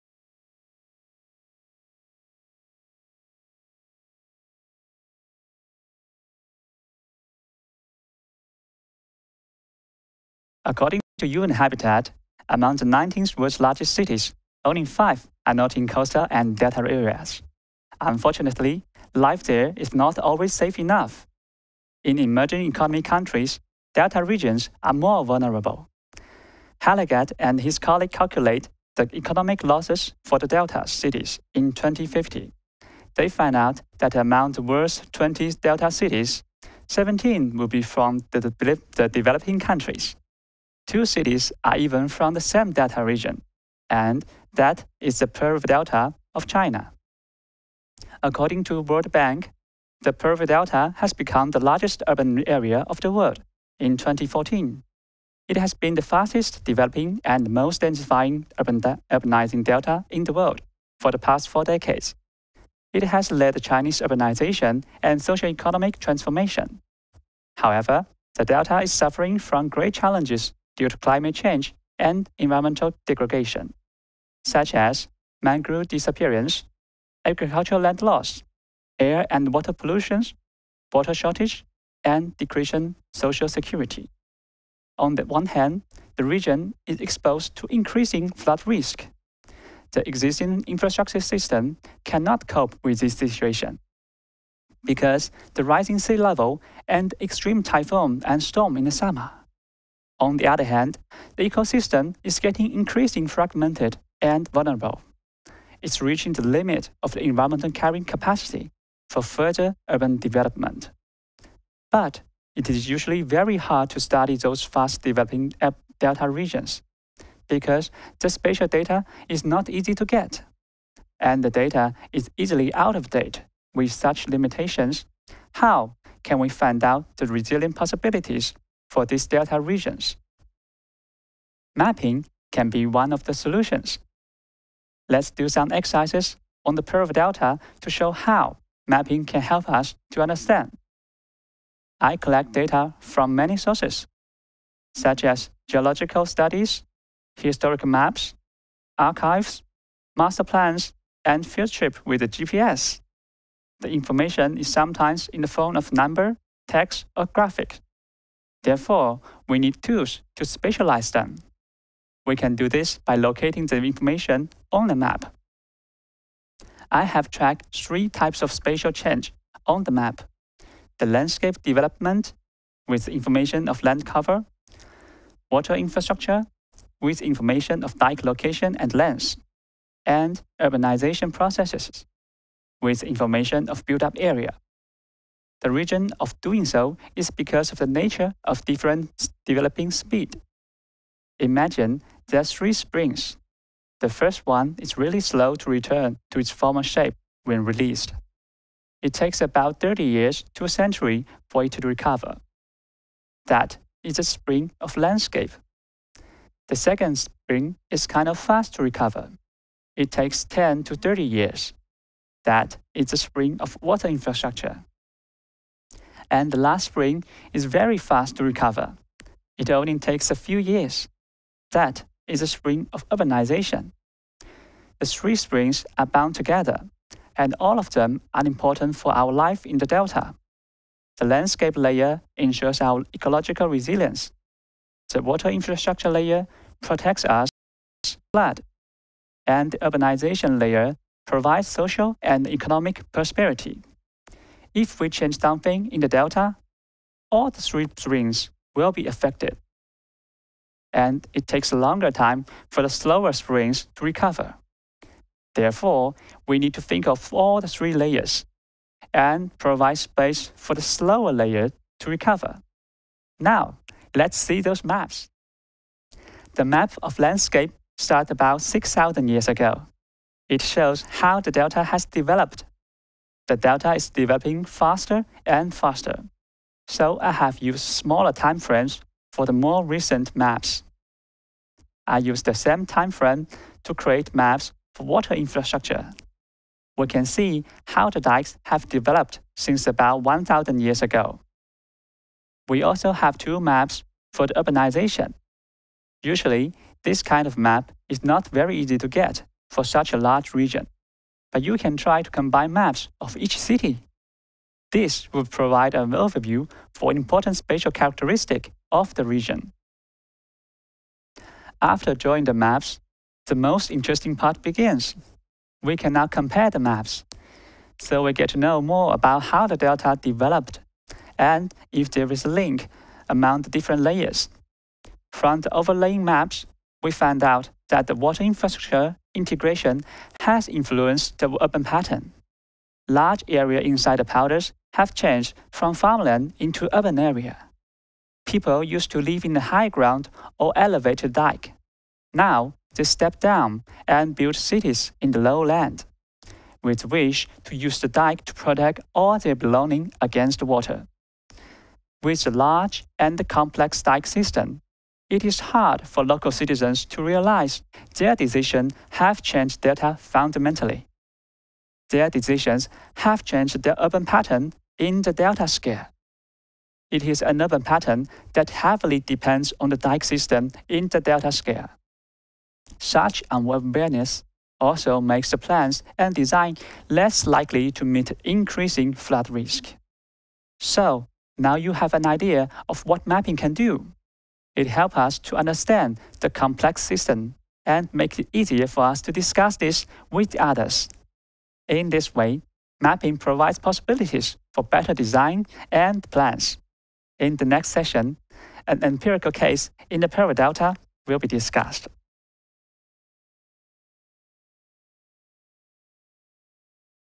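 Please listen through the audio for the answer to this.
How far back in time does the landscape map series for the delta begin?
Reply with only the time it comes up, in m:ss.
4:28.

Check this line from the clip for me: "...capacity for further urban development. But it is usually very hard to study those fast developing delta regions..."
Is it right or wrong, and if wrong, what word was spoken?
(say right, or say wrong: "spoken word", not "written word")
right.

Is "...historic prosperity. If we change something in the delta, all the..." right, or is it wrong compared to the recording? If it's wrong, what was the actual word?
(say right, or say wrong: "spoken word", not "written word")
wrong: "economic", not "historic".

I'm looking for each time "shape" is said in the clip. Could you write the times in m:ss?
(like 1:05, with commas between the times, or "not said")
3:16.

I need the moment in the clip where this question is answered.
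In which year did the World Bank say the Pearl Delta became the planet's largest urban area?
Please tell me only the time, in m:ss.
0:53.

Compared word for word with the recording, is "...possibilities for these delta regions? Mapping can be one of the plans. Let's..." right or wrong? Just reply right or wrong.
wrong.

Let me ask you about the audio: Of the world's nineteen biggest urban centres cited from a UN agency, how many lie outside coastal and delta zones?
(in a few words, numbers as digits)
5.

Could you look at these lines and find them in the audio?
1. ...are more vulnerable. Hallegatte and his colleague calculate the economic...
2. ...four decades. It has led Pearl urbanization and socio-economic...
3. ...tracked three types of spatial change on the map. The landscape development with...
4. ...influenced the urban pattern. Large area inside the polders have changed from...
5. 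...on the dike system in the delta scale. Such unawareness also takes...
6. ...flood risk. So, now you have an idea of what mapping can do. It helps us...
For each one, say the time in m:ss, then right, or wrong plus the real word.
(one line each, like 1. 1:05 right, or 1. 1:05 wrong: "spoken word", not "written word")
1. 0:24 right
2. 1:01 wrong: "Chinese", not "Pearl"
3. 2:47 right
4. 5:30 right
5. 6:09 wrong: "makes", not "takes"
6. 6:19 right.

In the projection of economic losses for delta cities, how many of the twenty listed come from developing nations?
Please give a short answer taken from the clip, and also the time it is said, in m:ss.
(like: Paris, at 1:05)
17, at 0:36.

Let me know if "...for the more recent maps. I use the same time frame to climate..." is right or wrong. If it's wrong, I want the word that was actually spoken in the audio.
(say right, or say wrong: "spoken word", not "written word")
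wrong: "create", not "climate".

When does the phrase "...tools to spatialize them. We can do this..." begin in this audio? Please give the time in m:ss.
2:39.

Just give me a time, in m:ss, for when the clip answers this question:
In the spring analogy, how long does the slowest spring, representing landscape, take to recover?
3:19.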